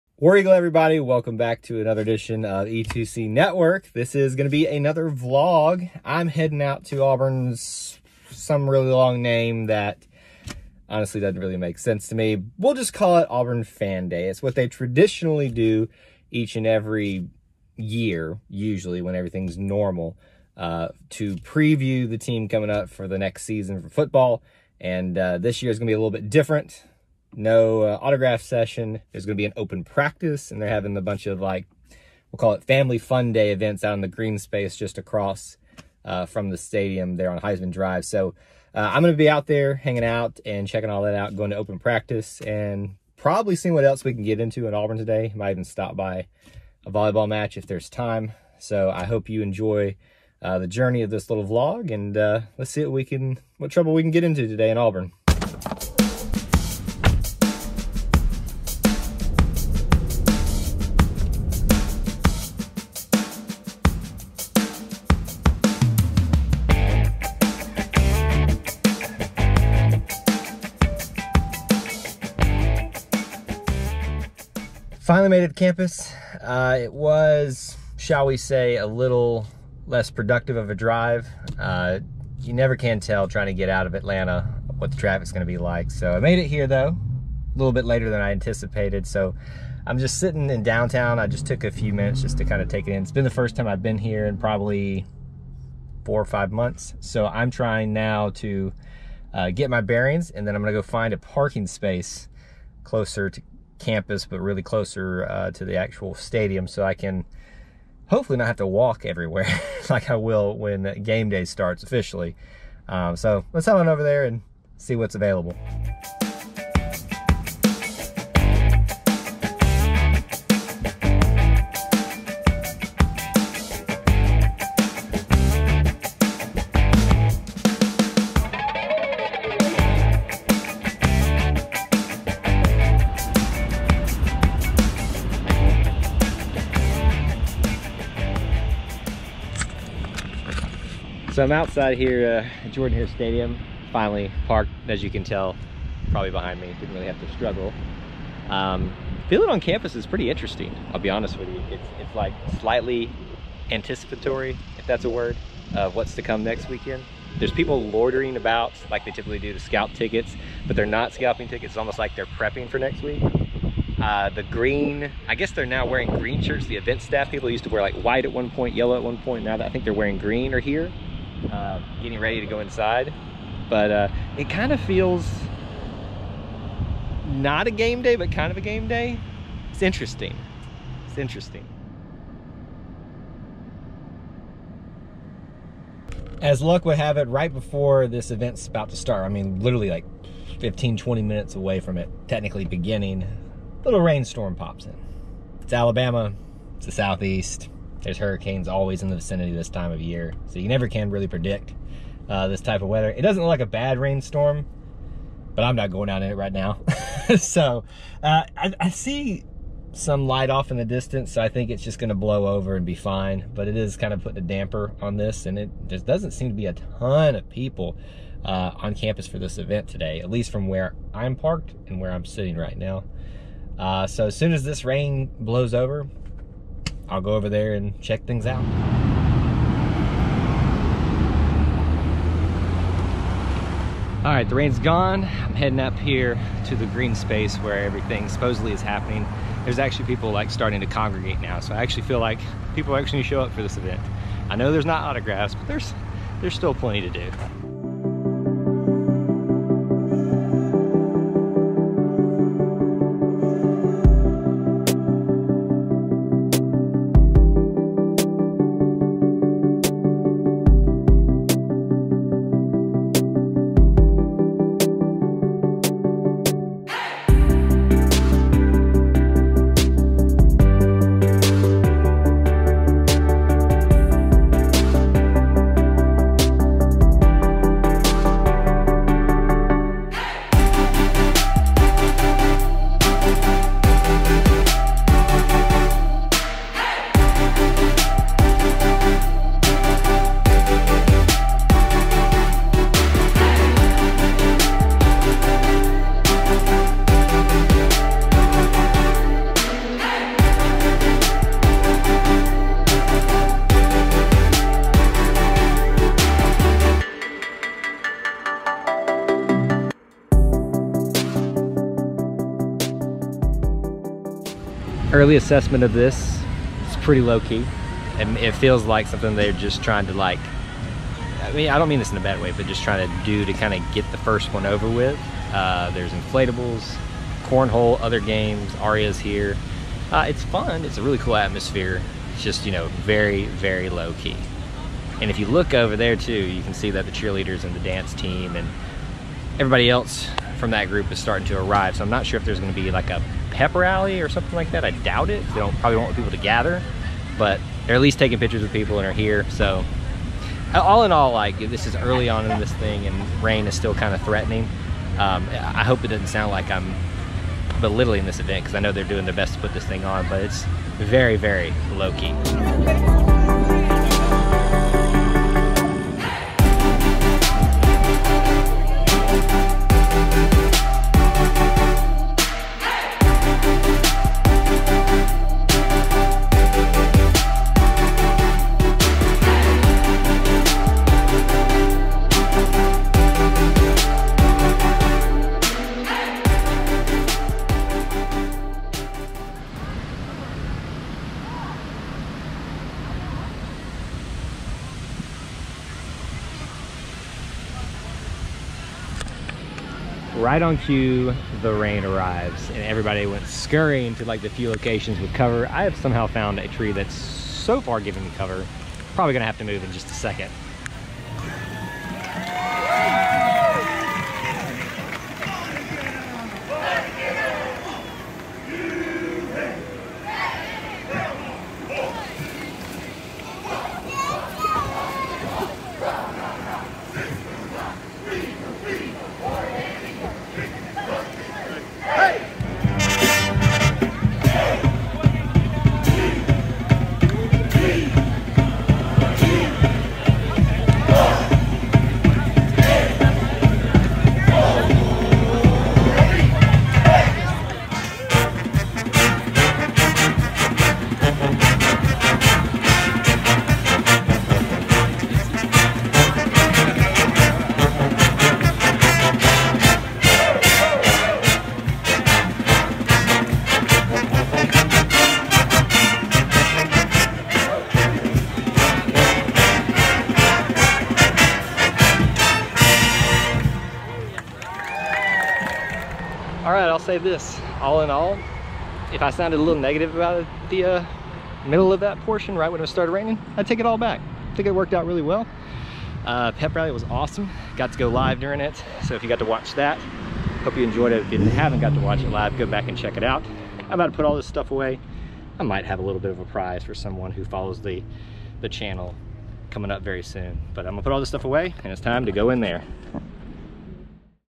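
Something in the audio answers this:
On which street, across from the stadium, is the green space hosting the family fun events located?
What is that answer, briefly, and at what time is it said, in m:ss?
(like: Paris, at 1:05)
Heisman Drive, at 0:37.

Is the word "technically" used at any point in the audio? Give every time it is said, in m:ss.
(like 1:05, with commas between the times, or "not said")
3:12.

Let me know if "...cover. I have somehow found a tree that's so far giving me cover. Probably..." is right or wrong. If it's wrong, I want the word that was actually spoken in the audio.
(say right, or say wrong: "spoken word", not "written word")
right.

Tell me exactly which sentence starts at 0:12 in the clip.
We'll just call it Auburn Fan Day.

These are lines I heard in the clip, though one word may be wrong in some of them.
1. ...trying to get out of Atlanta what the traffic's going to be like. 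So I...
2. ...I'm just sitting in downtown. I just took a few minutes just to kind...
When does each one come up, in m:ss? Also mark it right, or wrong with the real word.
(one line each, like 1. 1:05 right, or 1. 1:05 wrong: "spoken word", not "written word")
1. 1:23 right
2. 1:29 right.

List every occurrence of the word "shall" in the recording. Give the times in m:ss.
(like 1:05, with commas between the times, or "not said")
1:17.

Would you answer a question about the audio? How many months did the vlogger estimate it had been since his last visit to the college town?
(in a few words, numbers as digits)
4 or 5.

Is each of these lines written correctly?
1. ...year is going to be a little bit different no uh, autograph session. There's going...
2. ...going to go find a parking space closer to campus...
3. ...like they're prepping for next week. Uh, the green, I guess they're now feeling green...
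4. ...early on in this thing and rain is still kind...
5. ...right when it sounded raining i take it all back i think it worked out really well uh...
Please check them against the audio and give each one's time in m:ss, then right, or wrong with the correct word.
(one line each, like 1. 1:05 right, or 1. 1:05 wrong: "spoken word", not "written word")
1. 0:25 right
2. 1:40 right
3. 2:41 wrong: "wearing", not "feeling"
4. 5:51 right
5. 8:02 wrong: "started", not "sounded".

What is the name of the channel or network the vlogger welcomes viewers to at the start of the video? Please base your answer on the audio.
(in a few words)
E2C Network.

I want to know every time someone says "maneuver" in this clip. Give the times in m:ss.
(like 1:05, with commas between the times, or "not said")
not said.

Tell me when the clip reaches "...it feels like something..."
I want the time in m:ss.
5:18.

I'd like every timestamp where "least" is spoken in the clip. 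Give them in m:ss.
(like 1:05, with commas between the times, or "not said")
3:40, 5:48.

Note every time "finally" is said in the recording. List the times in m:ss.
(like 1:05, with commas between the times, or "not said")
1:15, 2:23.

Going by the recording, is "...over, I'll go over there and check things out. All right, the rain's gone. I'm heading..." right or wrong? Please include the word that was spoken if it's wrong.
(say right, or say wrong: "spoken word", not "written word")
right.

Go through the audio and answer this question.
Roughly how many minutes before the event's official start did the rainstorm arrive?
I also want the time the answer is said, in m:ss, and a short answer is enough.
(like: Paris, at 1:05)
15 to 20, at 3:10.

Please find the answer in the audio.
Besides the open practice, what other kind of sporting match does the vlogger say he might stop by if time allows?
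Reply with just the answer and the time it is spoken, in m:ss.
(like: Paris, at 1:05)
volleyball, at 0:46.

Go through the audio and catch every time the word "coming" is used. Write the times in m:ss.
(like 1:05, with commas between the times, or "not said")
0:22, 8:19.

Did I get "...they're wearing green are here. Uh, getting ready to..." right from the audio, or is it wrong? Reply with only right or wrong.
right.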